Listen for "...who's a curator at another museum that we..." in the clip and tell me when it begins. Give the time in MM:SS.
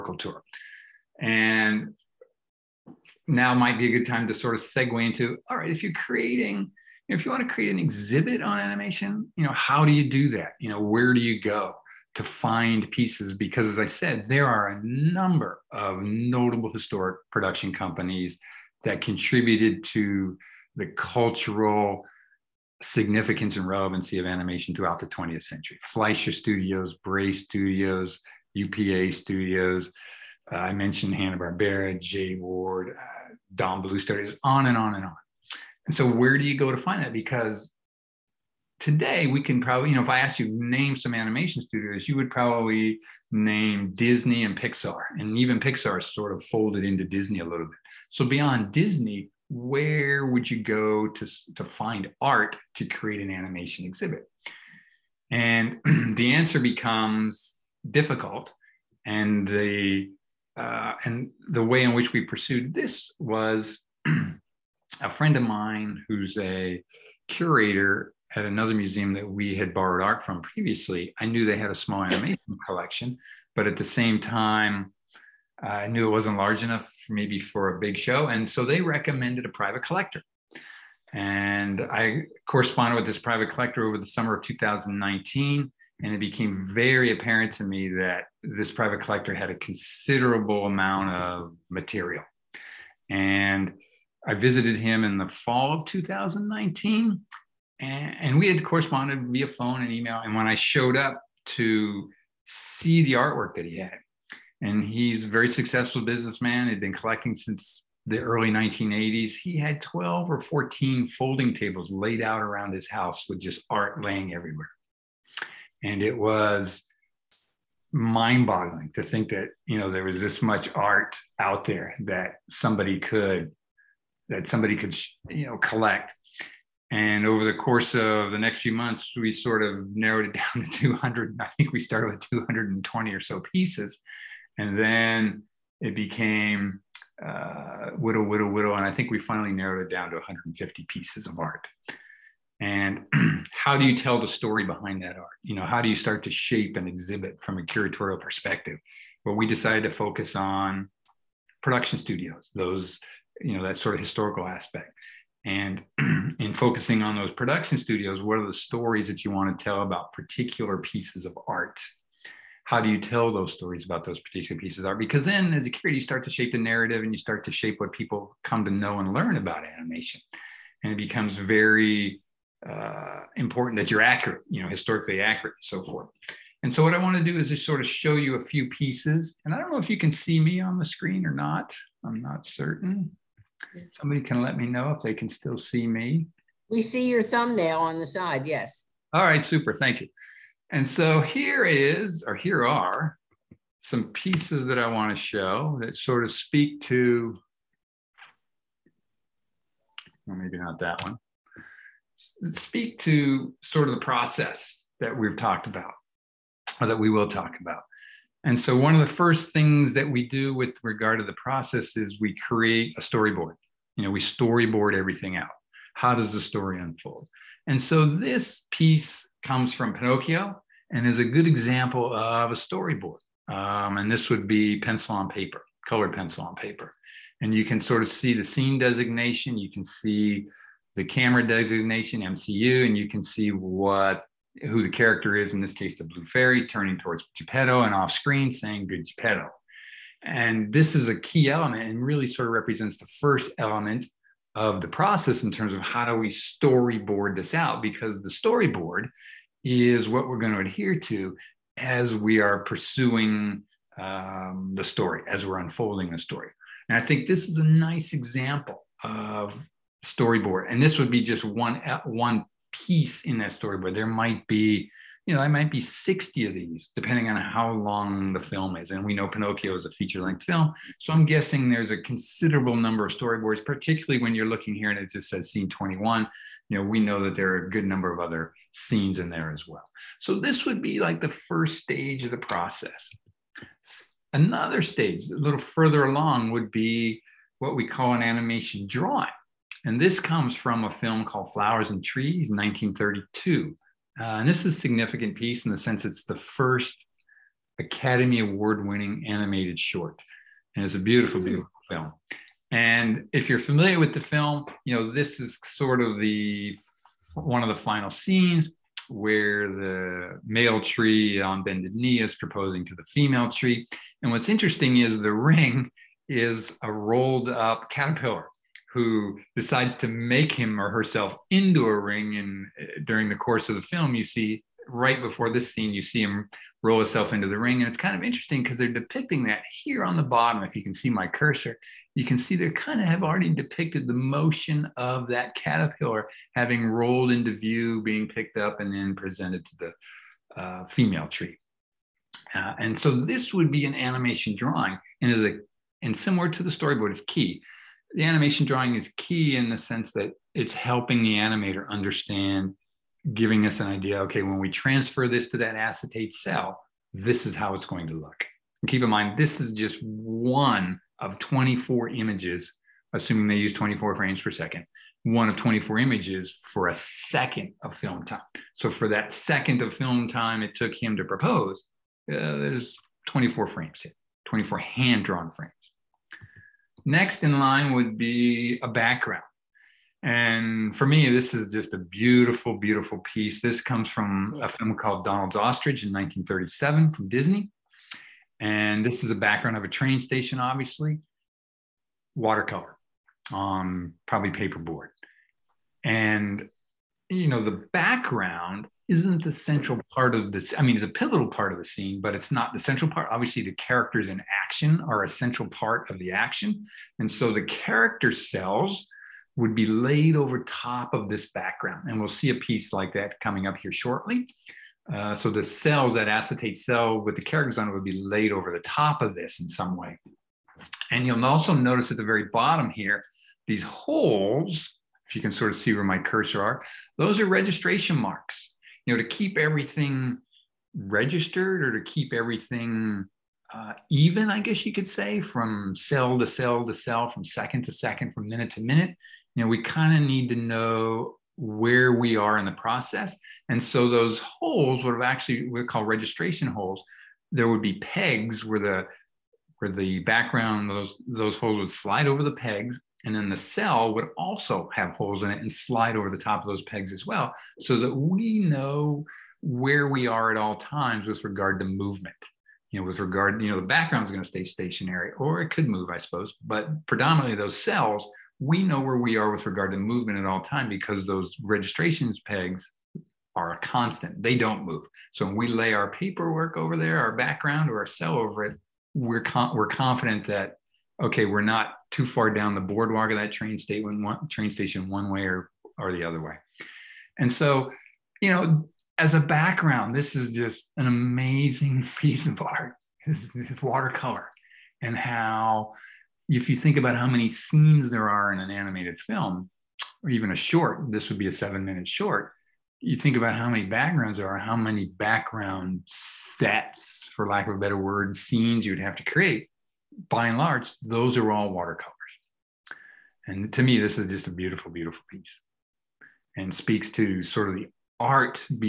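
01:06.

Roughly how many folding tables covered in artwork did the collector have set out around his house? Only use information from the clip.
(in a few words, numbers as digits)
12 or 14.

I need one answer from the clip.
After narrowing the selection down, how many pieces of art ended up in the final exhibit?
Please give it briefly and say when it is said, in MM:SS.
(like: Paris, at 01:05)
150, at 02:20.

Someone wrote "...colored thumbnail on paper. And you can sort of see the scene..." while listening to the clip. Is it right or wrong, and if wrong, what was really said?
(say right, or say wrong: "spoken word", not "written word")
wrong: "pencil", not "thumbnail".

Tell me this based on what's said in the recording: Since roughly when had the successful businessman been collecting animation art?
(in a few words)
early 1980s.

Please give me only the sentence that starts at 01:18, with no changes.
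And so they recommended a private collector.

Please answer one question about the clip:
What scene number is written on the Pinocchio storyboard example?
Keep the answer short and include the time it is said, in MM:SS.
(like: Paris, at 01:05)
21, at 04:35.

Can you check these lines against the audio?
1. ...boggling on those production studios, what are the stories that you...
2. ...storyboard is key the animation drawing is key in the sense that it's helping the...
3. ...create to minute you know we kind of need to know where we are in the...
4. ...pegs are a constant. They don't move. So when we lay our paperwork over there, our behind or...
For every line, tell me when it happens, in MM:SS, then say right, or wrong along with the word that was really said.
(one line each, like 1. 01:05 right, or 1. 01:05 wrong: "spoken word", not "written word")
1. 02:36 wrong: "focusing", not "boggling"
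2. 05:46 right
3. 07:18 wrong: "minute", not "create"
4. 07:52 wrong: "background", not "behind".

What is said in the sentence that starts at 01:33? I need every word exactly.
And I visited him in the fall of 2019 and, and we had corresponded via phone and email.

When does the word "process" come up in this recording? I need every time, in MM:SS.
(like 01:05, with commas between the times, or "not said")
03:24, 03:31, 04:04, 04:42, 07:22.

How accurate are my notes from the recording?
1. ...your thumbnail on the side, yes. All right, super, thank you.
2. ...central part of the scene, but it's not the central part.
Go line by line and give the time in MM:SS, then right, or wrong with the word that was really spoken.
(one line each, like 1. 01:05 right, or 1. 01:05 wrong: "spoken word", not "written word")
1. 03:07 right
2. 06:41 wrong: "pivotal", not "central".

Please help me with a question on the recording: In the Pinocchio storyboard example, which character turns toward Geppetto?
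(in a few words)
the Blue Fairy.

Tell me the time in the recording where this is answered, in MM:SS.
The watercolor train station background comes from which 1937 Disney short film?
06:25.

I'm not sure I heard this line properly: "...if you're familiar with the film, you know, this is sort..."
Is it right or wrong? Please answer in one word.
right.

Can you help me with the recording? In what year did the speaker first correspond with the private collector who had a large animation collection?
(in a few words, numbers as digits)
2019.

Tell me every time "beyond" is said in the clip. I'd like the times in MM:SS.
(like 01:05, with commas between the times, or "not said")
00:48.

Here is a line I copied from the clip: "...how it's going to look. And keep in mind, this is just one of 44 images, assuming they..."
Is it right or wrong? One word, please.
wrong.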